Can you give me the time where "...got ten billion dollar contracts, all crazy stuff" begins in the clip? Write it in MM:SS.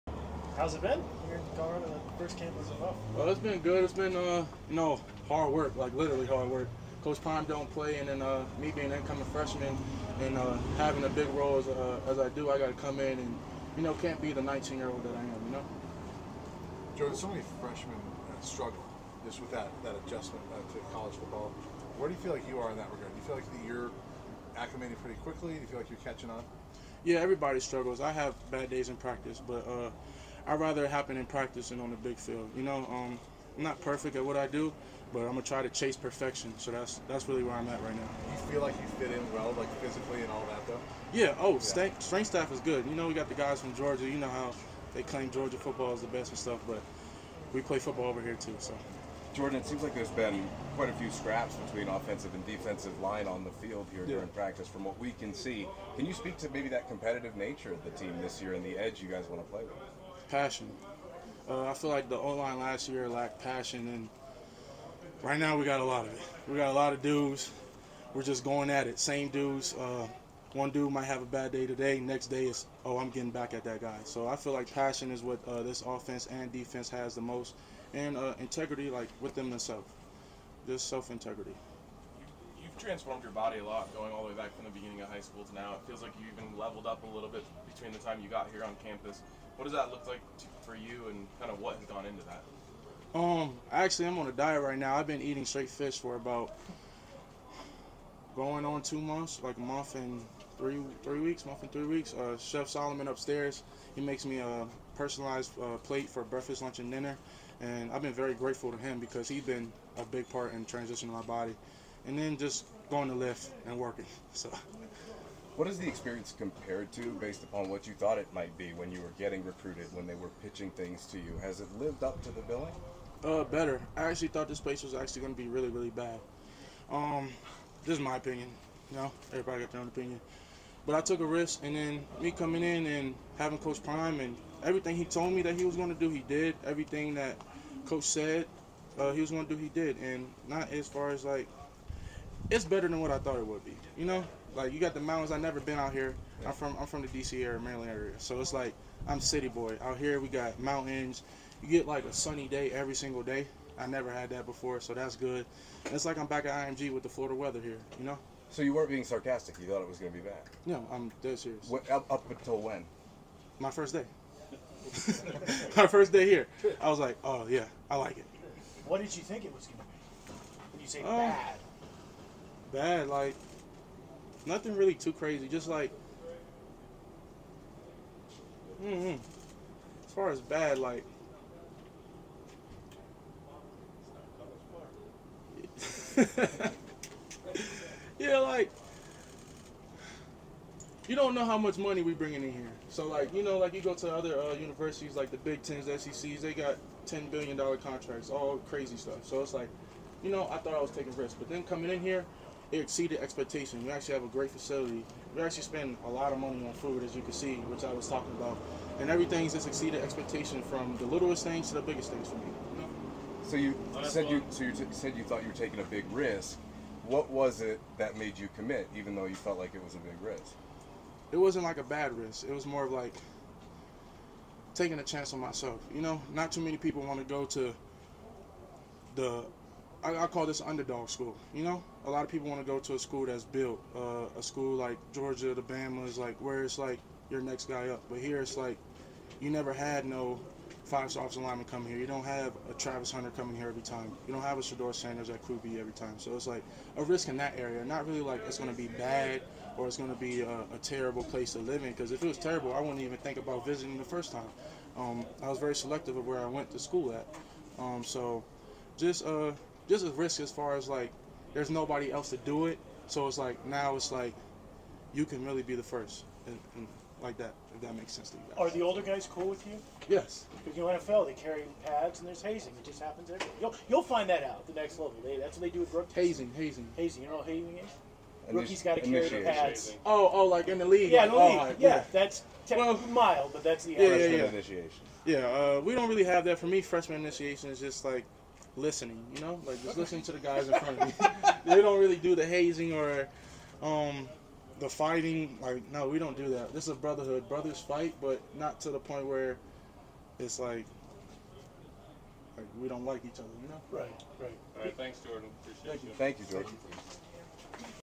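03:16.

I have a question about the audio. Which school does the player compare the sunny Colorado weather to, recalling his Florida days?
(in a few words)
IMG.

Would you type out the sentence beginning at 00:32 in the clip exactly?
You know, um, I'm not perfect at what I do, but I'm gonna try to chase perfection.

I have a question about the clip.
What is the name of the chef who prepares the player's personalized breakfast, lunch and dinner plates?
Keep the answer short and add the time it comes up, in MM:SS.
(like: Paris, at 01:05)
Chef Solomon, at 01:42.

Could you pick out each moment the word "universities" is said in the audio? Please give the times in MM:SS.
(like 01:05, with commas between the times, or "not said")
03:14.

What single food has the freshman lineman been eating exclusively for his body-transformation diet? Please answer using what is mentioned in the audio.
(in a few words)
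Fish.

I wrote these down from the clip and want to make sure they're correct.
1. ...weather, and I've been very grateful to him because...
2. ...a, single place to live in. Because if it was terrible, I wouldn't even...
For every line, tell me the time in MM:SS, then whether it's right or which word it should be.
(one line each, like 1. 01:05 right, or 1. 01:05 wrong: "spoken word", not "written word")
1. 01:46 wrong: "dinner", not "weather"
2. 04:10 wrong: "terrible", not "single".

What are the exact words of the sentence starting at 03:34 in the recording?
you so you said you thought you were taking a big risk.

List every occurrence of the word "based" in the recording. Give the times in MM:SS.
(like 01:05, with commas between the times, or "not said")
01:57.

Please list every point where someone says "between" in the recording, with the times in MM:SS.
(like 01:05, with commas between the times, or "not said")
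00:51, 01:27.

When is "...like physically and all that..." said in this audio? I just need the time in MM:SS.
00:39.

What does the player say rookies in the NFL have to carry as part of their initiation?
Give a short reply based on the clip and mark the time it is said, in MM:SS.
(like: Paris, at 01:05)
Their pads, at 04:39.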